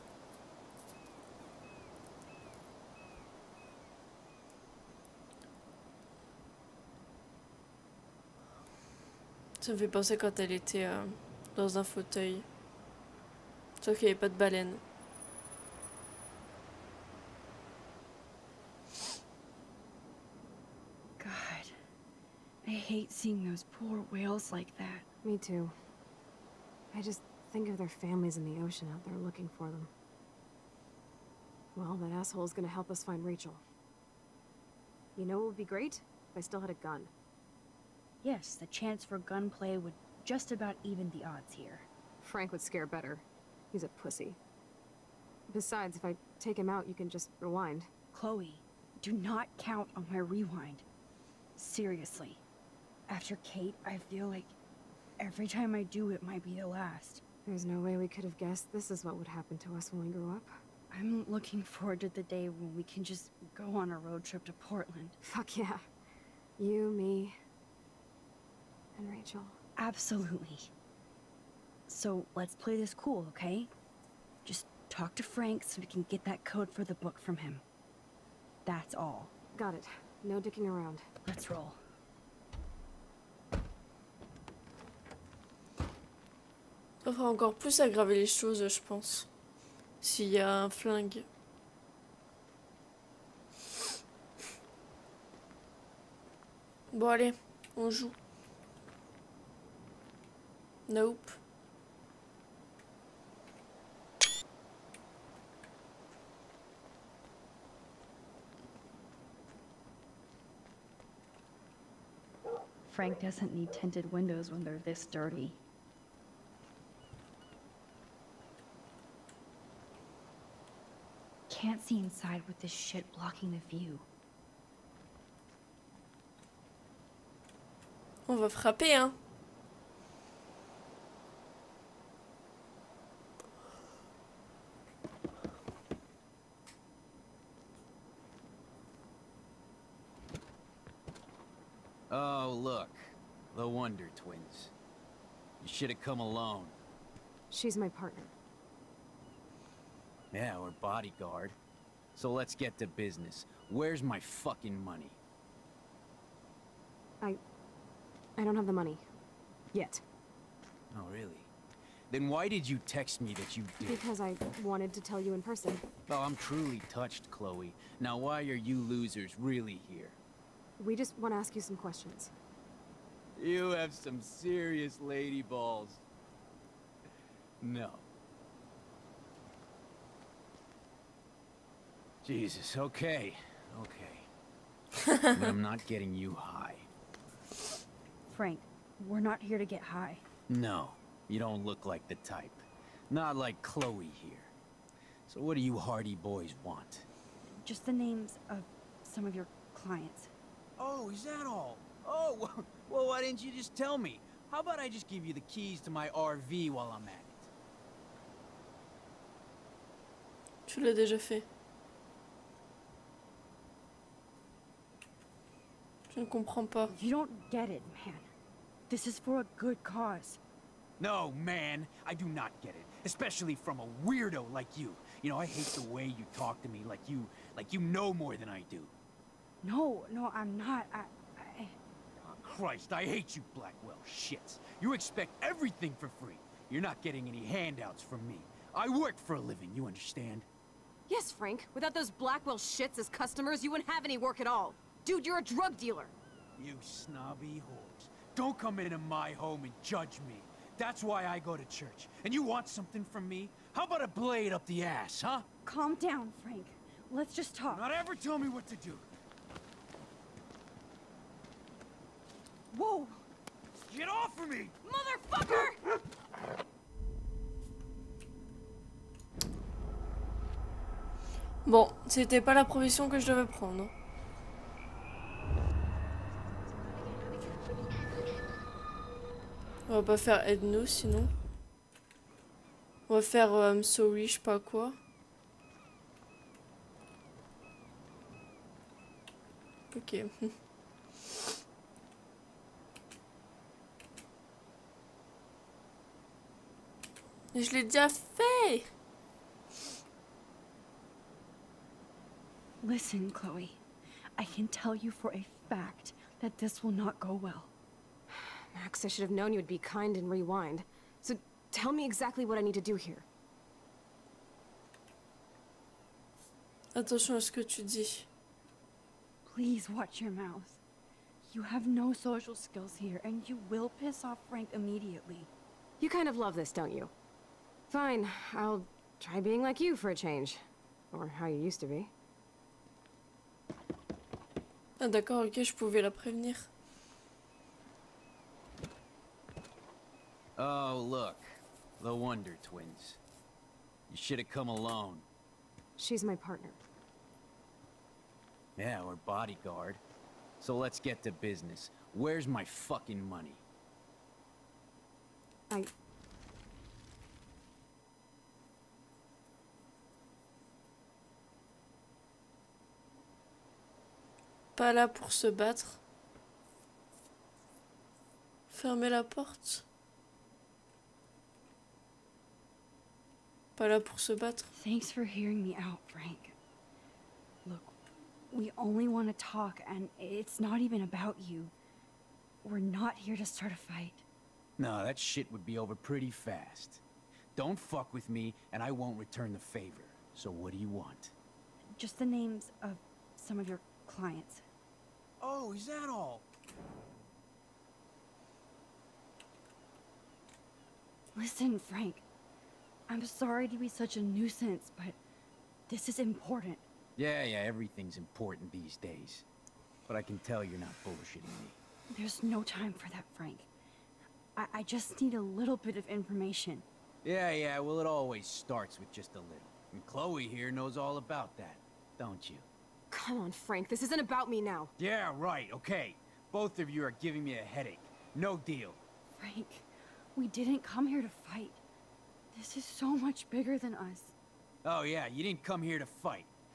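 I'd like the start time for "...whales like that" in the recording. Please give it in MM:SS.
00:24.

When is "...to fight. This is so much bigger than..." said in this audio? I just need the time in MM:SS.
07:11.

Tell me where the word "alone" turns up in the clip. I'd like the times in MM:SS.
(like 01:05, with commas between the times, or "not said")
02:26, 05:44.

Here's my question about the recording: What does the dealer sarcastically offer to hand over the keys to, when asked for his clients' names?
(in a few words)
RV.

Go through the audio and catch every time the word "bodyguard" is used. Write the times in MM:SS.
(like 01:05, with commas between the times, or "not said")
02:30, 05:49.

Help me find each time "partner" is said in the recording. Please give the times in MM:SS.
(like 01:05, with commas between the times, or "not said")
02:27, 05:46.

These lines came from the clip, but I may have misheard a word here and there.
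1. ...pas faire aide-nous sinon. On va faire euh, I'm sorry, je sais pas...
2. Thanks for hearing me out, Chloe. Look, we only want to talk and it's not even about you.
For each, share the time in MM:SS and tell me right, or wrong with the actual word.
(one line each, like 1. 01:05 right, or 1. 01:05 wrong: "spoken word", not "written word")
1. 04:40 right
2. 06:14 wrong: "Frank", not "Chloe".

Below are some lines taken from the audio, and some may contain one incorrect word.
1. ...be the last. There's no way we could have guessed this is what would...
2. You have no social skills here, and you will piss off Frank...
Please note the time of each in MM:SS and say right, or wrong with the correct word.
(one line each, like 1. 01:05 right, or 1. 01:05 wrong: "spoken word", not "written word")
1. 00:56 right
2. 05:21 right.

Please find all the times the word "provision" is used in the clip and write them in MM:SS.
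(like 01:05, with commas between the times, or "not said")
04:32.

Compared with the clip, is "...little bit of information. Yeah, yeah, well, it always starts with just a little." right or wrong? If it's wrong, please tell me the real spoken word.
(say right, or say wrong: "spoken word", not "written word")
right.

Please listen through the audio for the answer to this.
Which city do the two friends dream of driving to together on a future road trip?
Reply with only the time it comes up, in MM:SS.
01:04.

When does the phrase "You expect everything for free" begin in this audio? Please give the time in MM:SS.
03:54.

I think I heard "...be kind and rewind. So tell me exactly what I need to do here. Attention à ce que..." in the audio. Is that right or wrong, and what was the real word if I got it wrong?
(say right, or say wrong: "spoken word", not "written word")
right.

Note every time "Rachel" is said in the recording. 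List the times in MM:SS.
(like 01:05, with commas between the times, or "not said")
00:33, 01:09.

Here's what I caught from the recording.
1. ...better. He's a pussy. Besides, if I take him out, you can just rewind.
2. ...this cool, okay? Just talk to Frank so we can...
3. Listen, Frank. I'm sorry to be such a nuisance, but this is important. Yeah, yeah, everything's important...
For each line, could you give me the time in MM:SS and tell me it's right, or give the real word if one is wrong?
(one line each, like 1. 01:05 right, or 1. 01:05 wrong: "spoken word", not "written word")
1. 00:42 right
2. 01:12 right
3. 06:41 right.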